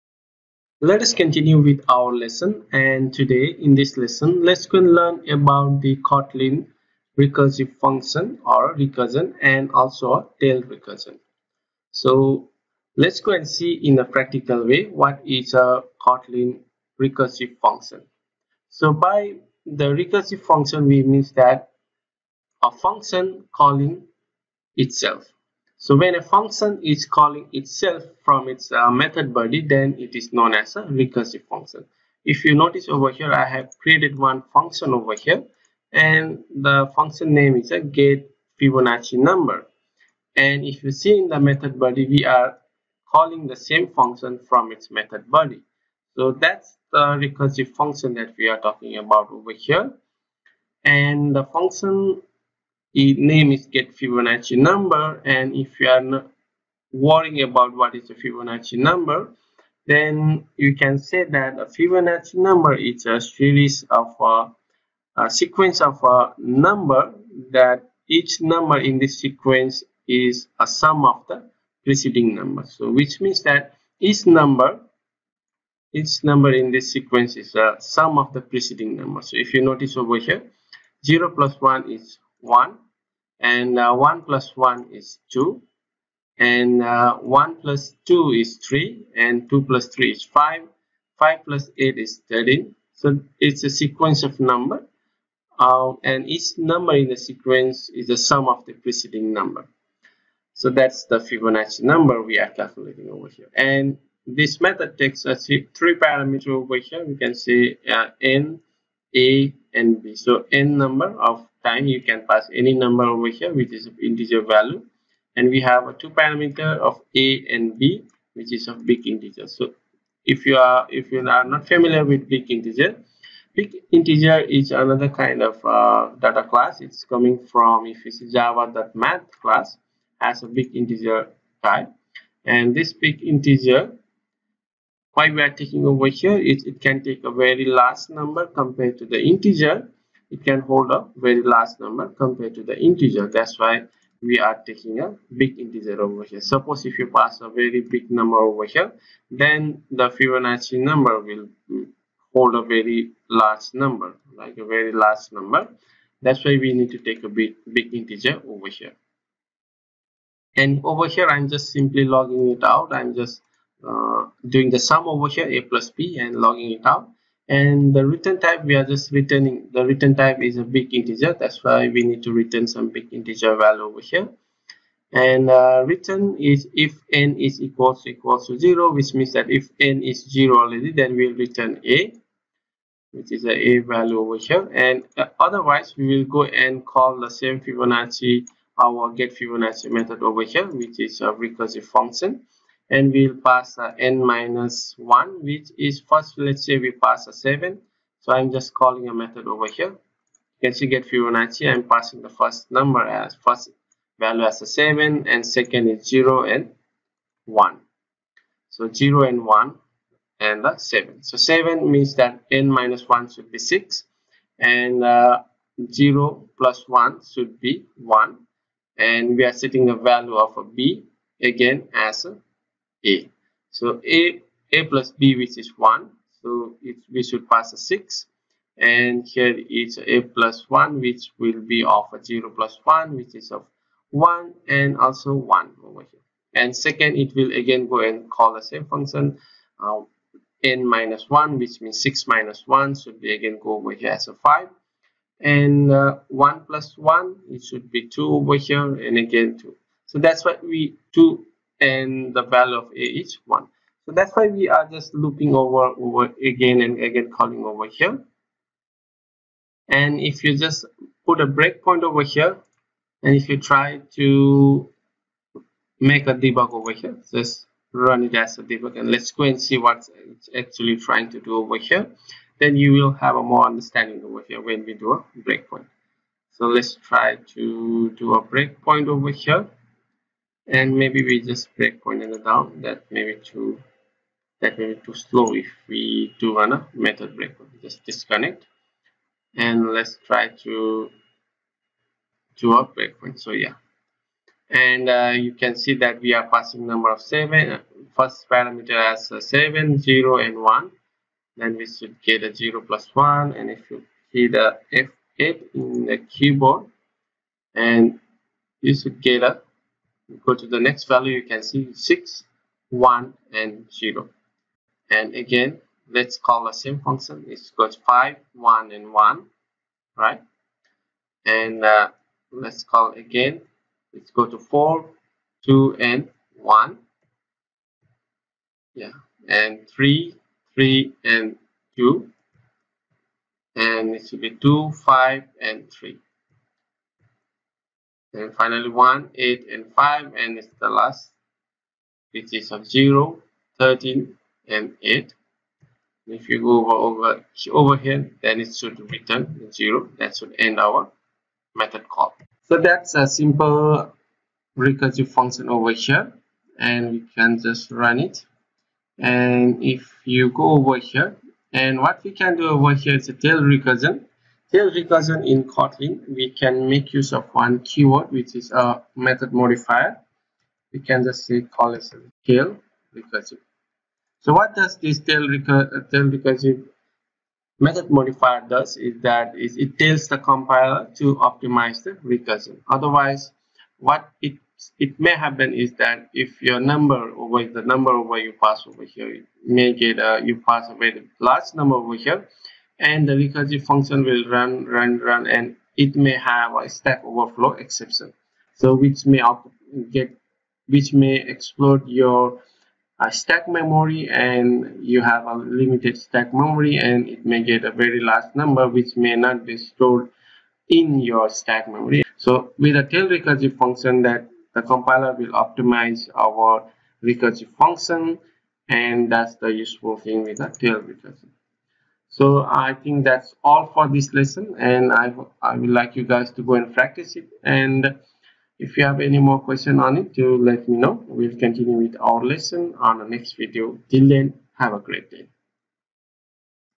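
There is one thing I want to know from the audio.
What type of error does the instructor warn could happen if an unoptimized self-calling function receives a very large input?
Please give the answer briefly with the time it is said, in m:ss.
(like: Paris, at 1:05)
stack overflow exception, at 6:36.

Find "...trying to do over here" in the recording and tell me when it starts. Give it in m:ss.
4:30.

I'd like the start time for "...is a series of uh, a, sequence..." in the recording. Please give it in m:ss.
1:02.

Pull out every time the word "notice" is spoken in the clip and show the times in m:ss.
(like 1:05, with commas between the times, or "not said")
0:32, 1:19.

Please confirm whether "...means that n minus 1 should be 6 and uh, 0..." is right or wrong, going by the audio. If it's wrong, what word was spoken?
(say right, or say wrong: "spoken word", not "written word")
right.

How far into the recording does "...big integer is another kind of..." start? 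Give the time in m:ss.
2:03.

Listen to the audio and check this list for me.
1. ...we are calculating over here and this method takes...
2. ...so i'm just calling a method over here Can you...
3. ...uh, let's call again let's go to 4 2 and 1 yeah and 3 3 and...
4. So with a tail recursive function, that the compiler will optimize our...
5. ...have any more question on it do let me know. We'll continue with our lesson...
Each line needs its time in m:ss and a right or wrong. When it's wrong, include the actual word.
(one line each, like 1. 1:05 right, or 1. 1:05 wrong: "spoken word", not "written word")
1. 1:42 right
2. 3:18 right
3. 5:21 right
4. 6:52 right
5. 7:09 right.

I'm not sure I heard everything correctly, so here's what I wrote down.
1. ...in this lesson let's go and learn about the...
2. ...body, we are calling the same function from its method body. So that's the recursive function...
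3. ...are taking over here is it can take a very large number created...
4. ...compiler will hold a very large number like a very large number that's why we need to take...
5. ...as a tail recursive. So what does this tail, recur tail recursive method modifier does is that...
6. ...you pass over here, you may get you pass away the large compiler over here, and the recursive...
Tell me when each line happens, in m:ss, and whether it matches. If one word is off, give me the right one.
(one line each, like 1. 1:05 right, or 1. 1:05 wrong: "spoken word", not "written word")
1. 0:03 right
2. 0:41 right
3. 2:15 wrong: "compared", not "created"
4. 2:30 wrong: "number", not "compiler"
5. 6:11 right
6. 6:28 wrong: "number", not "compiler".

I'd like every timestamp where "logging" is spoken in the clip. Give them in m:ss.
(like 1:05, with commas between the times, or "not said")
2:42, 2:46.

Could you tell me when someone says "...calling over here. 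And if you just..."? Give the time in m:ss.
4:17.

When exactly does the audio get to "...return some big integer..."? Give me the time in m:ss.
2:52.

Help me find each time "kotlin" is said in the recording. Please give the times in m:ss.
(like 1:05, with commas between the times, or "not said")
0:05, 0:16, 6:05.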